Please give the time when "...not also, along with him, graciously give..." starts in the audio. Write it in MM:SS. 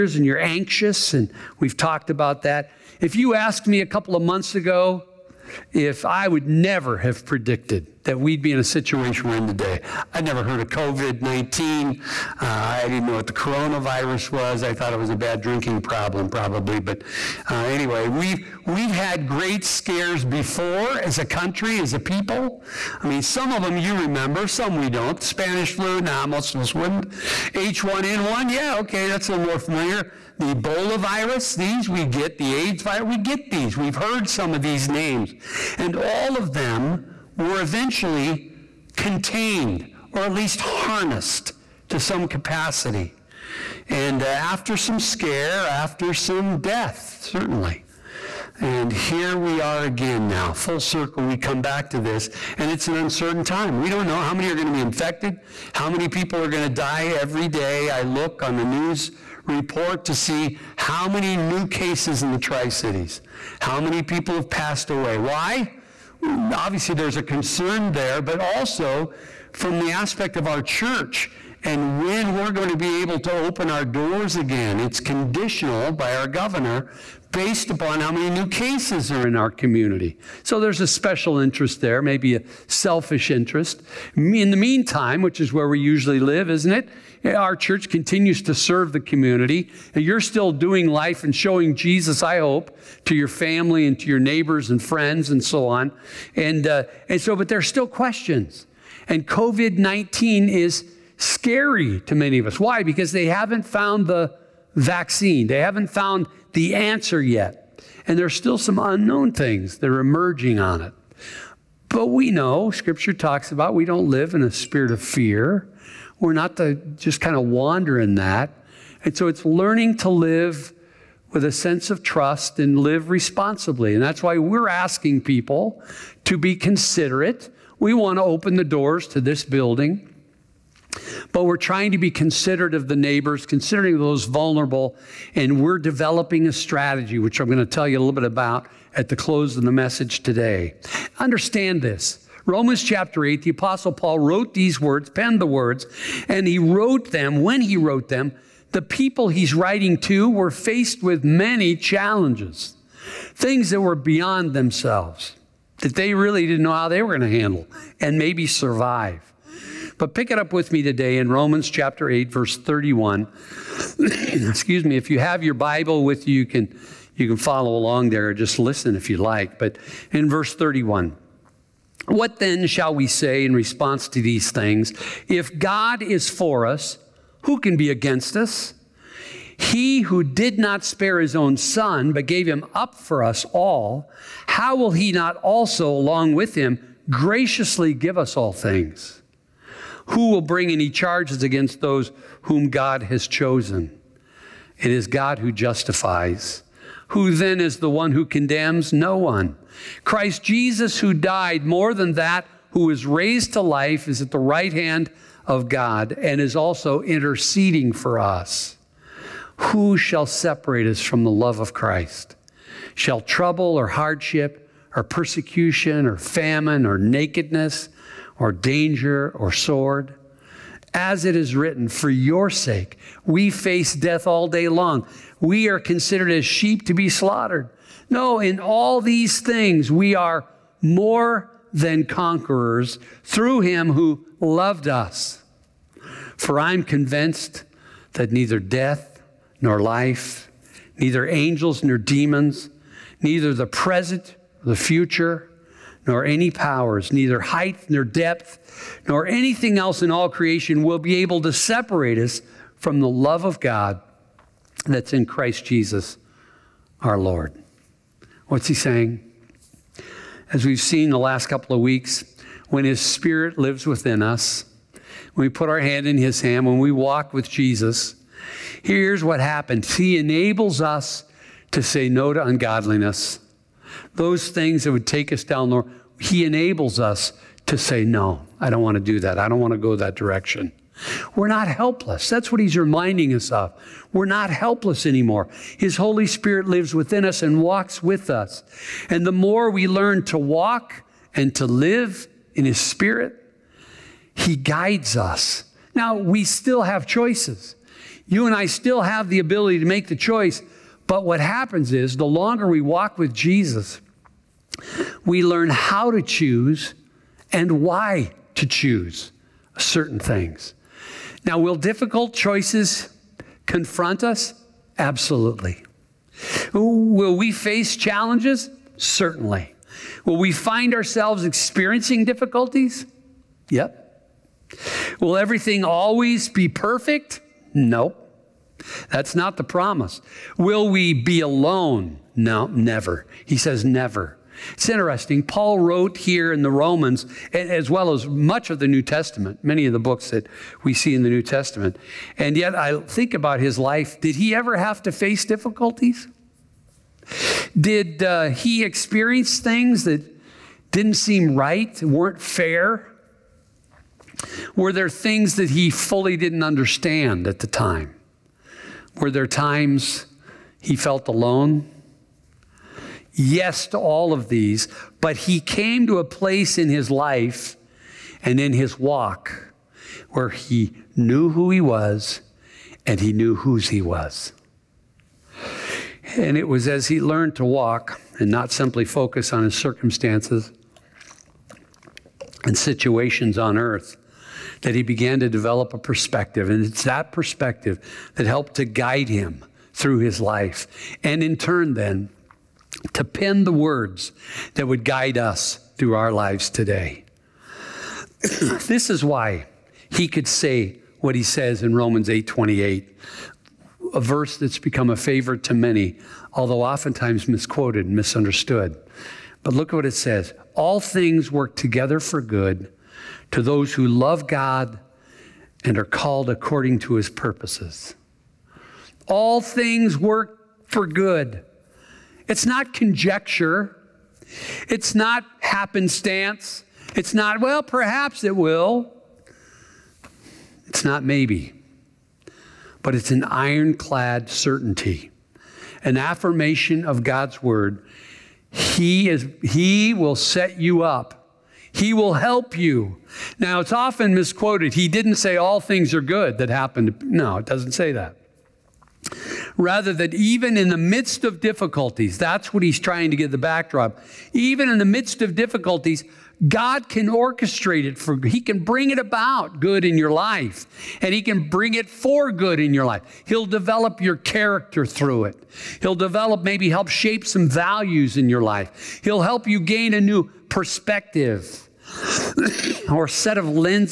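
03:05.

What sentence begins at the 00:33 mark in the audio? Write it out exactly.
We've heard some of these names.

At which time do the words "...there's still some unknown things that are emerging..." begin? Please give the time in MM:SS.
01:48.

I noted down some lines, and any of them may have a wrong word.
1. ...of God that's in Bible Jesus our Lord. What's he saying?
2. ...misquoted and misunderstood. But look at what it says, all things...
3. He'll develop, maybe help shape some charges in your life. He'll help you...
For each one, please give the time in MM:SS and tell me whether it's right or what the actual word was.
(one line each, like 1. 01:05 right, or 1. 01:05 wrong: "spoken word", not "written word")
1. 04:13 wrong: "Christ", not "Bible"
2. 06:47 right
3. 07:46 wrong: "values", not "charges".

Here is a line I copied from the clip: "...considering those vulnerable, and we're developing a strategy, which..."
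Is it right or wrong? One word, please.
right.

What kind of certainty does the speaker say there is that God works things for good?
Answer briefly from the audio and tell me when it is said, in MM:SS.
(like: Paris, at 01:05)
Ironclad certainty, at 07:13.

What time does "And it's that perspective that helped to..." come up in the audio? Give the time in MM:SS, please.
06:26.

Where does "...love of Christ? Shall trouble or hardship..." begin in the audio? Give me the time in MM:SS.
03:31.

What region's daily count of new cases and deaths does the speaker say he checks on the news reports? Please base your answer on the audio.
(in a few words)
Tri Cities.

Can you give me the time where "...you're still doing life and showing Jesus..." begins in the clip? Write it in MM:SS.
01:30.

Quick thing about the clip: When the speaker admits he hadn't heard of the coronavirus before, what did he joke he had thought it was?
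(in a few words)
A bad drinking problem.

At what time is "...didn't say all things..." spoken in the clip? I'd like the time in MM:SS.
07:25.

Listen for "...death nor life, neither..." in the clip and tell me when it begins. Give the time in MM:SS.
03:58.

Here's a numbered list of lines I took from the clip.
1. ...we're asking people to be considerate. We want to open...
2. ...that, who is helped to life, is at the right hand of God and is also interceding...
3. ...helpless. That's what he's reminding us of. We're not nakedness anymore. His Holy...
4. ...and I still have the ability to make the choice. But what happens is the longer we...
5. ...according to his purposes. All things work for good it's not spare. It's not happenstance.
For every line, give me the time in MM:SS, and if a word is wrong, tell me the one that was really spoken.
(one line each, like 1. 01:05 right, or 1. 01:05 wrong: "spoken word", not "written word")
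1. 02:04 right
2. 03:22 wrong: "raised", not "helped"
3. 04:41 wrong: "helpless", not "nakedness"
4. 04:58 right
5. 06:56 wrong: "conjecture", not "spare".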